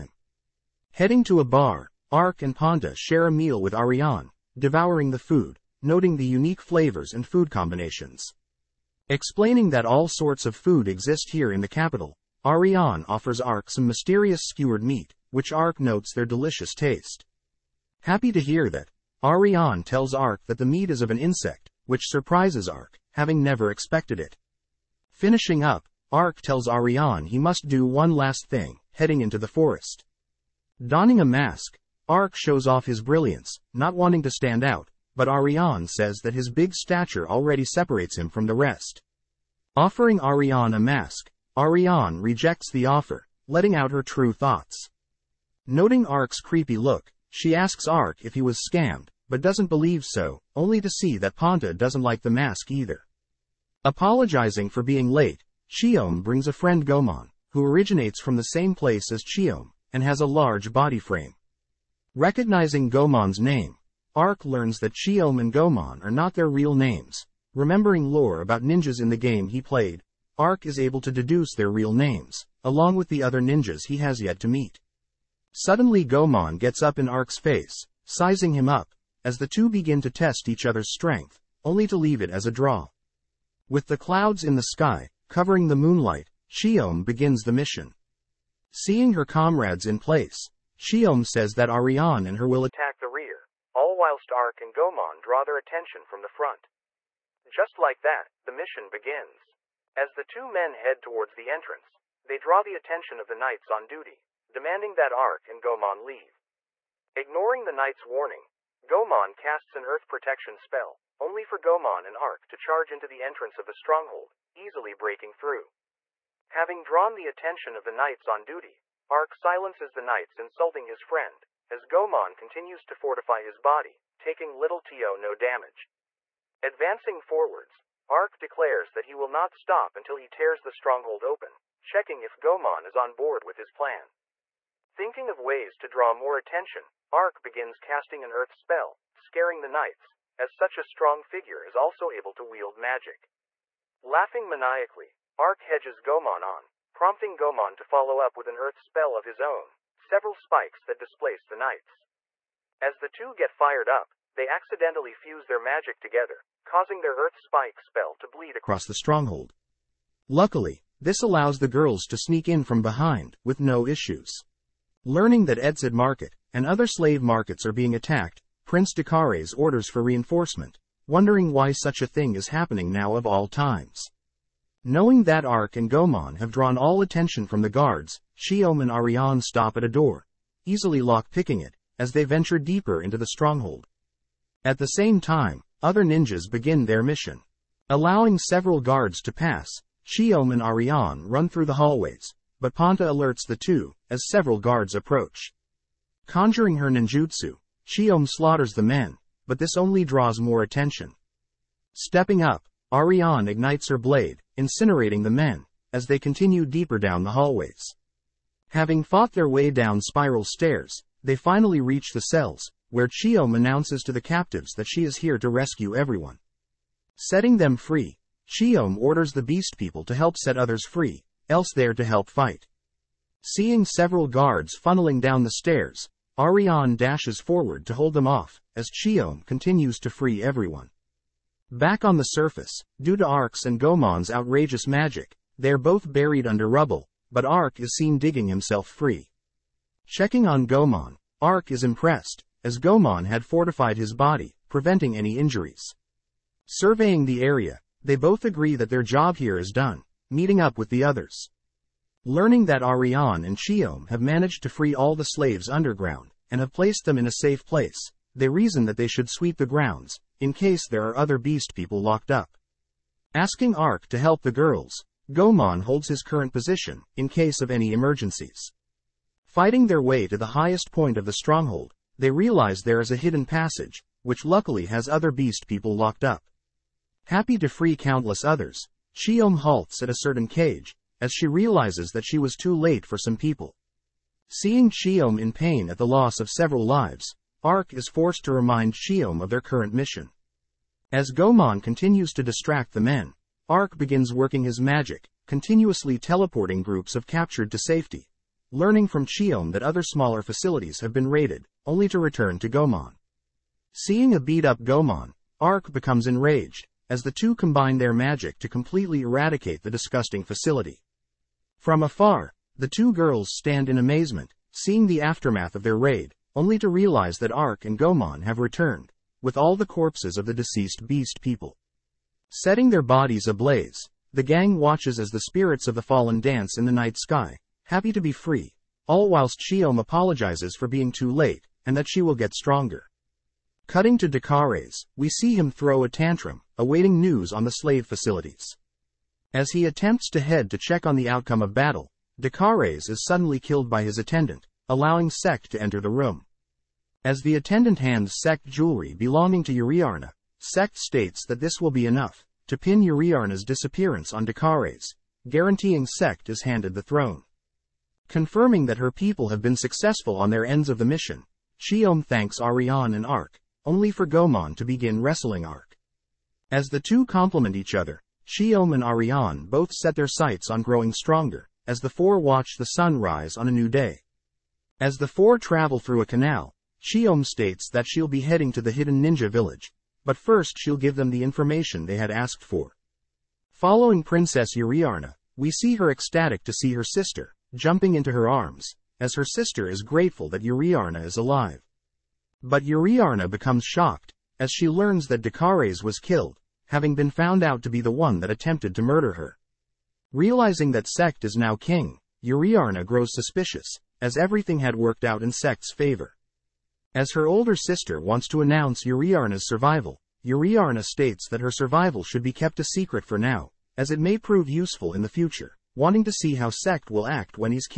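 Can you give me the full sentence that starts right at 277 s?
Happy to free countless others, Chiyome halts at a certain cage, as she realizes that she was too late for some people.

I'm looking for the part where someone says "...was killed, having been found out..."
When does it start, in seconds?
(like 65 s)
396 s.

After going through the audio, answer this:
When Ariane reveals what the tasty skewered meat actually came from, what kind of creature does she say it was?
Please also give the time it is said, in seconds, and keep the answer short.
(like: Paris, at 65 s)
An insect, at 21 s.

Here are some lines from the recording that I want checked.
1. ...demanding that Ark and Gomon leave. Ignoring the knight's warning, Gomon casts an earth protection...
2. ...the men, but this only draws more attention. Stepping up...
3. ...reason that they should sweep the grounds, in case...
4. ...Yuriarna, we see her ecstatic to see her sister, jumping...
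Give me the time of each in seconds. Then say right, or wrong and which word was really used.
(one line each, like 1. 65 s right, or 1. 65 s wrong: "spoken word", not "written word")
1. 104 s right
2. 198 s right
3. 258 s right
4. 384 s right.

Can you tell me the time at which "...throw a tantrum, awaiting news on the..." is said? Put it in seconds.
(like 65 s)
335 s.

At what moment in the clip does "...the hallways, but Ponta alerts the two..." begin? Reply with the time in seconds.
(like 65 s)
191 s.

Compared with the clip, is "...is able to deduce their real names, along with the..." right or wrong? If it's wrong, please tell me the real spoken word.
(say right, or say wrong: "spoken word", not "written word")
right.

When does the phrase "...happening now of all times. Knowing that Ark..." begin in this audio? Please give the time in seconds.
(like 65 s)
172 s.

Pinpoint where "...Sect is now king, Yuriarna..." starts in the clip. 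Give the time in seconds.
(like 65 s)
401 s.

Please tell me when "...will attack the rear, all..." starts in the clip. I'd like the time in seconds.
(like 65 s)
92 s.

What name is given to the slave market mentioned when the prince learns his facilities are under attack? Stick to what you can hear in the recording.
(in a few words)
Edzid Market.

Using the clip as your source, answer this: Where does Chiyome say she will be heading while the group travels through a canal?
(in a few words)
The hidden ninja village.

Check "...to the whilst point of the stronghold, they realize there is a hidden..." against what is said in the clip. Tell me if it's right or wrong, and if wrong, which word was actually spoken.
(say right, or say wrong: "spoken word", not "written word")
wrong: "highest", not "whilst".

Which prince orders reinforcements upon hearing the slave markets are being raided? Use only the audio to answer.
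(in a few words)
Prince Dakares.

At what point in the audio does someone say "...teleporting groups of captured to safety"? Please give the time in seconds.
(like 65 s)
296 s.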